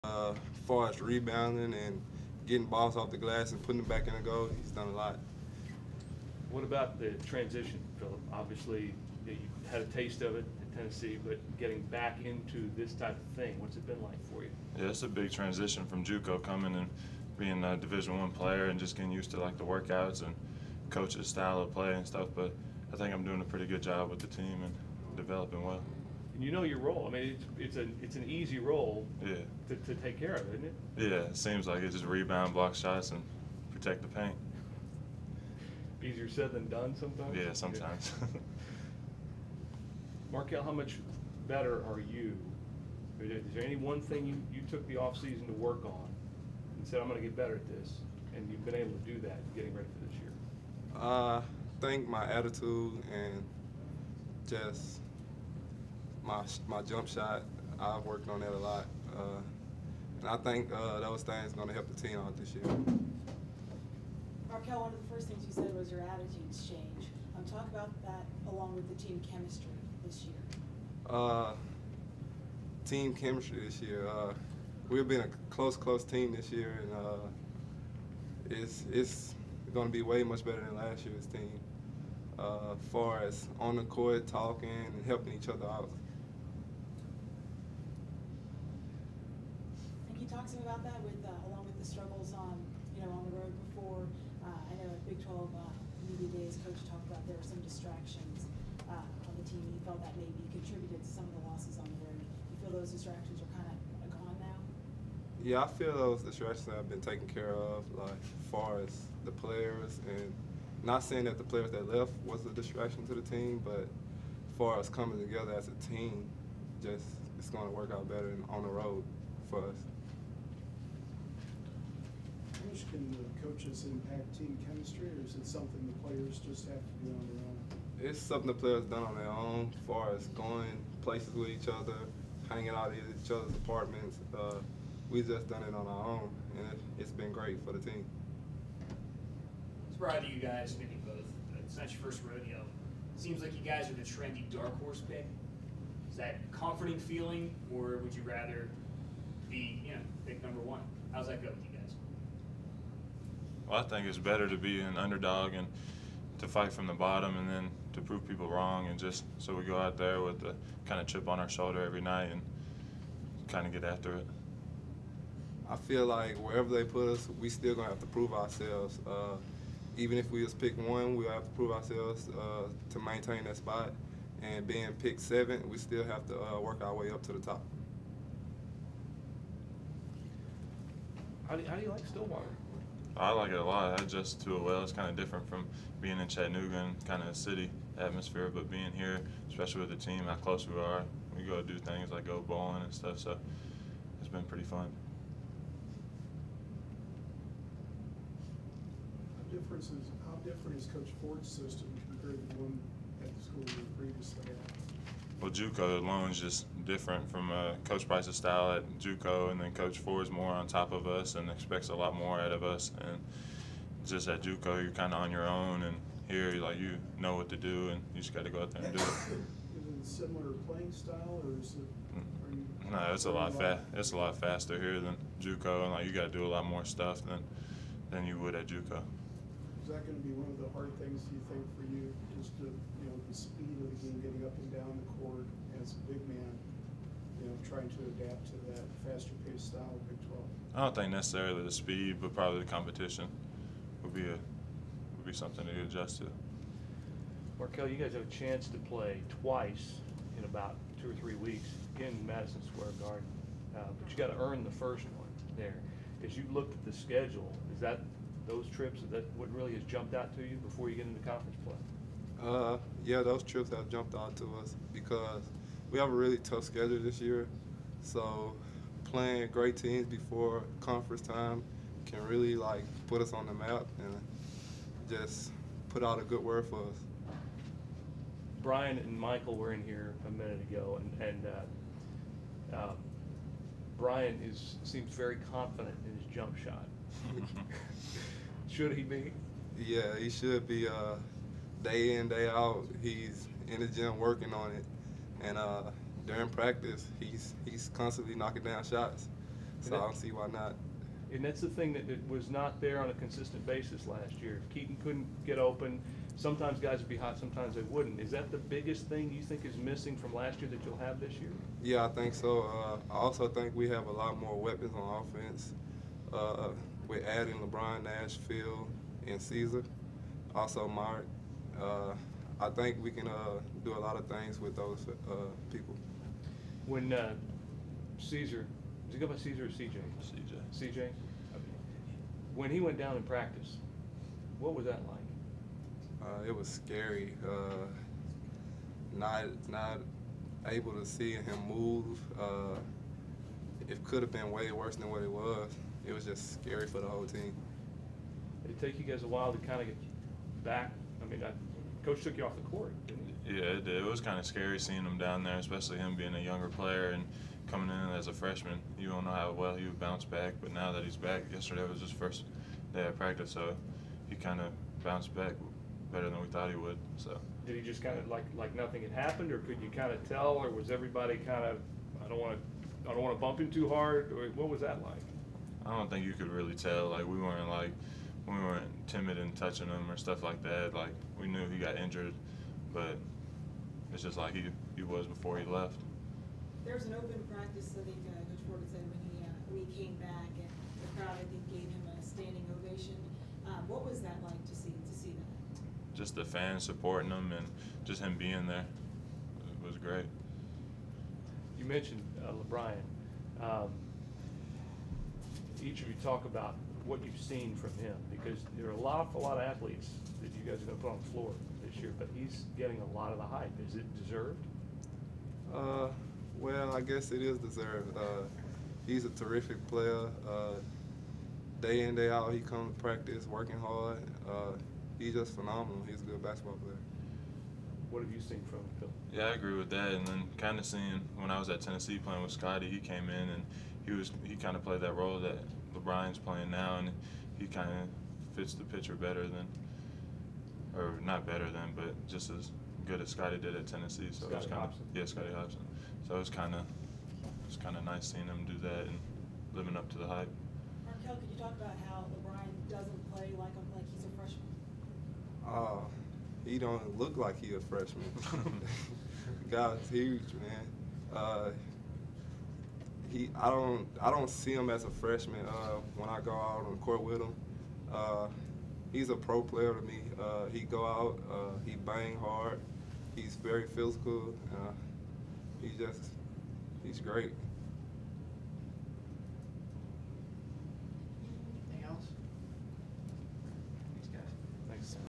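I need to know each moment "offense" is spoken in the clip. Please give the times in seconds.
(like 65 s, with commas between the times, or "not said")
315 s.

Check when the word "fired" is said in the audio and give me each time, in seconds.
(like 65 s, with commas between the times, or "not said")
not said.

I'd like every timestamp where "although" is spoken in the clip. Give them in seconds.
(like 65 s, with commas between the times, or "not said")
not said.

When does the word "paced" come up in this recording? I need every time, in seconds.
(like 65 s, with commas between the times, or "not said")
239 s.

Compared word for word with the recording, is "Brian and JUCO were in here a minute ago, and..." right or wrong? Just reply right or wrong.
wrong.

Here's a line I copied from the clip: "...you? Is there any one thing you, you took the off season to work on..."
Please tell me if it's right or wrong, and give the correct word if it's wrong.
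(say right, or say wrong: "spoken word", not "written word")
right.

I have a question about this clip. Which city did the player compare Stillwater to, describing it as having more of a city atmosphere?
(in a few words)
Chattanooga.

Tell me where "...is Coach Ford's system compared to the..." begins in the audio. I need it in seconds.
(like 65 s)
200 s.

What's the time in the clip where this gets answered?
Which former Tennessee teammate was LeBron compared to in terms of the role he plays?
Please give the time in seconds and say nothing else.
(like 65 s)
445 s.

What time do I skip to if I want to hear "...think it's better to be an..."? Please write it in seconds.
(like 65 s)
153 s.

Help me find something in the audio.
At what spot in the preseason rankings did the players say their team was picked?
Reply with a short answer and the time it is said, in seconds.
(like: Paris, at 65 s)
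seventh, at 175 s.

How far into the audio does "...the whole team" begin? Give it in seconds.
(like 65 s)
346 s.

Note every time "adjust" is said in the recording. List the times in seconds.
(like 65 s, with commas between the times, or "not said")
184 s, 245 s.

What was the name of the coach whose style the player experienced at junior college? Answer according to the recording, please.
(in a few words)
Coach Price.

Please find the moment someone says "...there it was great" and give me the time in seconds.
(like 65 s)
398 s.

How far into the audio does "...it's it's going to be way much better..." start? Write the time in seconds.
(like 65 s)
78 s.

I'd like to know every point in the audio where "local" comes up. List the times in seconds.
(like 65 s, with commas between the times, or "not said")
not said.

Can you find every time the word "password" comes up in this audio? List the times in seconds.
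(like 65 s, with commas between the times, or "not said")
not said.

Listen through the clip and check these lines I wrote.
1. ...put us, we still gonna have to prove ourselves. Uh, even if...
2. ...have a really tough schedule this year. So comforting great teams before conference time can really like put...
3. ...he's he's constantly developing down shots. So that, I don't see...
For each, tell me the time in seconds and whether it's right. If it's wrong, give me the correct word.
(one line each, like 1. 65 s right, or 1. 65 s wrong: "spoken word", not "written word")
1. 166 s right
2. 265 s wrong: "playing", not "comforting"
3. 297 s wrong: "knocking", not "developing".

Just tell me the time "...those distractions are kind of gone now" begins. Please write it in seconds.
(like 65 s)
102 s.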